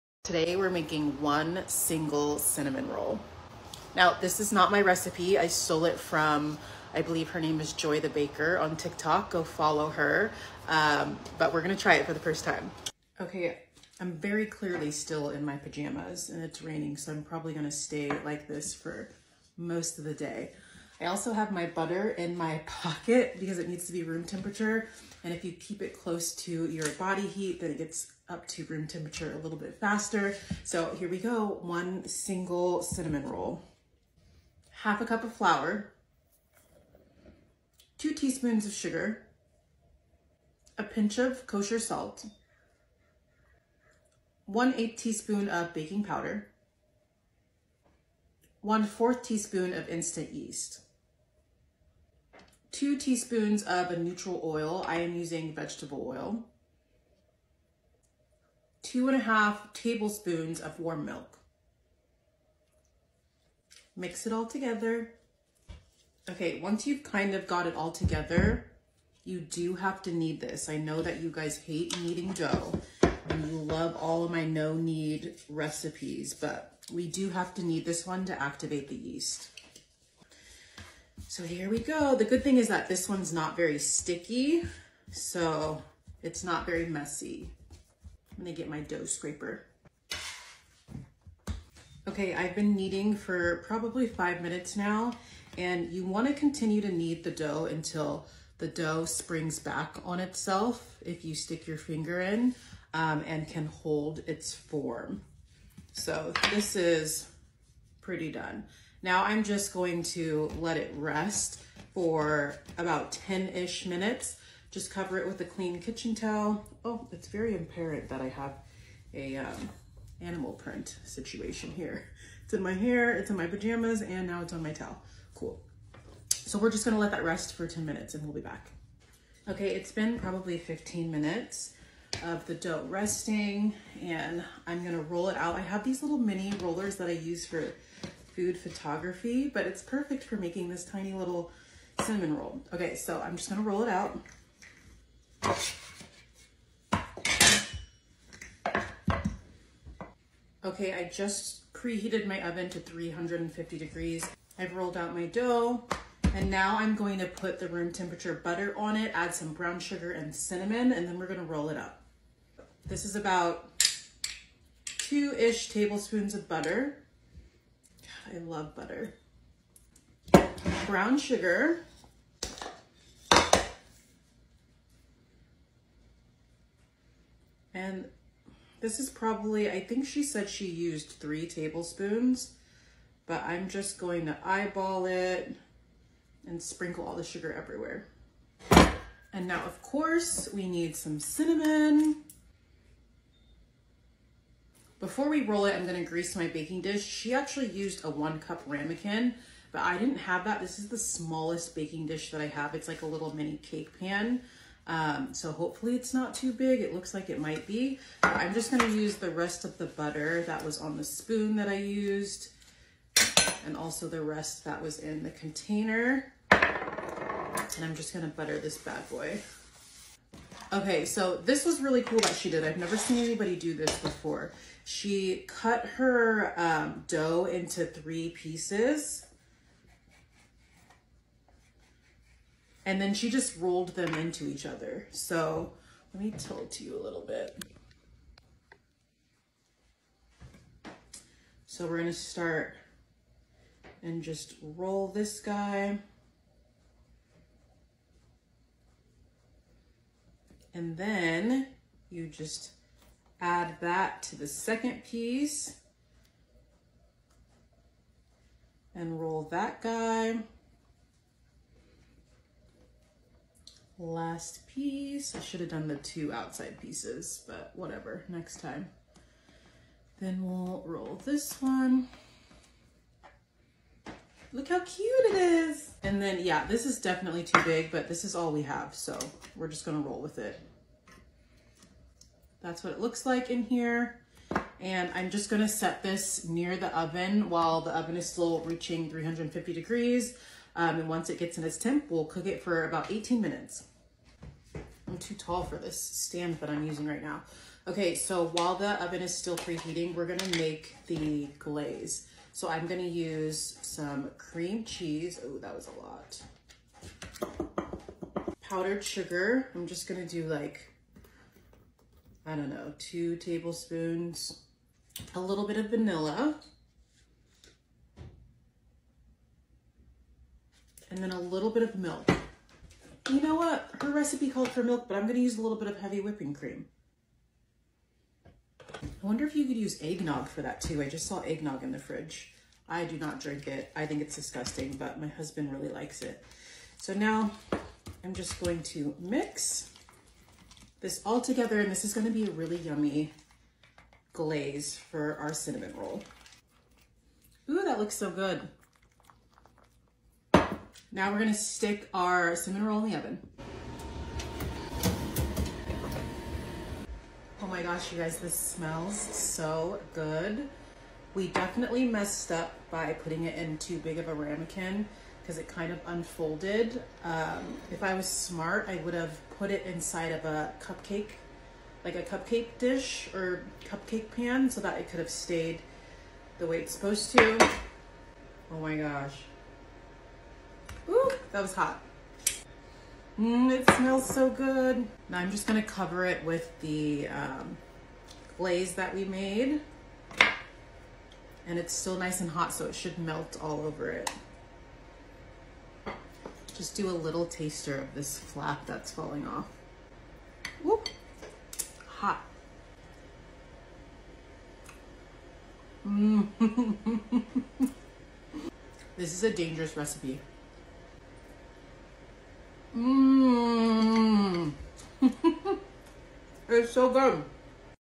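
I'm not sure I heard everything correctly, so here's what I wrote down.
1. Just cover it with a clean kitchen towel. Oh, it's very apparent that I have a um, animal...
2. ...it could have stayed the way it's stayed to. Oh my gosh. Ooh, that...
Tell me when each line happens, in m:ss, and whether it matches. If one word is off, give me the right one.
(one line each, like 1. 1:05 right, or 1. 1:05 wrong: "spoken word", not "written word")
1. 1:54 right
2. 6:14 wrong: "supposed", not "stayed".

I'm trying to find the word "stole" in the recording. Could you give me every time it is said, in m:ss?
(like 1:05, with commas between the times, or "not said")
0:05.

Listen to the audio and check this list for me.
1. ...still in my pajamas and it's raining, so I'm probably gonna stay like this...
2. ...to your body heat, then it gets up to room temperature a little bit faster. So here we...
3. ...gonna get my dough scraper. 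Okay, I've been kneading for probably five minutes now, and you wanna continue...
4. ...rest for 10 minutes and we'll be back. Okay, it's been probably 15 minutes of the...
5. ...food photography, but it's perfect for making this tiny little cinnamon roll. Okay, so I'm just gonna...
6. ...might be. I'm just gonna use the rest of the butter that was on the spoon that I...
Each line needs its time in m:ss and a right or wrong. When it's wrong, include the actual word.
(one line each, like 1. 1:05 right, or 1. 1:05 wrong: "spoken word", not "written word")
1. 0:14 right
2. 0:26 right
3. 1:28 right
4. 2:07 right
5. 2:18 right
6. 3:27 right.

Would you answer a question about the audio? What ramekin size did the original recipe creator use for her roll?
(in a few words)
1 cup.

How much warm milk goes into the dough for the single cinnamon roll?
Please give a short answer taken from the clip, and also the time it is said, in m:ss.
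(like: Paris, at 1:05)
2 and a half tablespoons, at 0:58.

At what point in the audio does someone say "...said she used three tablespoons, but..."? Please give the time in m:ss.
3:00.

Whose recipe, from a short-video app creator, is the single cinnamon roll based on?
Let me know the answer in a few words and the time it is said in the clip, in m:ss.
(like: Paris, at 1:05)
Joy the Baker, at 0:07.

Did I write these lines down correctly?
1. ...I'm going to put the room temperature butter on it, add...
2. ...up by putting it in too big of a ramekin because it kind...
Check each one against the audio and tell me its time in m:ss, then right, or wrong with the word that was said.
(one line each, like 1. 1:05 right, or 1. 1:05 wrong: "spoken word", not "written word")
1. 2:36 right
2. 6:02 right.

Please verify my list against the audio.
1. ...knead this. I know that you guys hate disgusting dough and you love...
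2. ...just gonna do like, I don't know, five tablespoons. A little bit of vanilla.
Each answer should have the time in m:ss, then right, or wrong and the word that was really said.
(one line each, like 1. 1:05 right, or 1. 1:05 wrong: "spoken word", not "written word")
1. 1:10 wrong: "kneading", not "disgusting"
2. 5:09 wrong: "two", not "five".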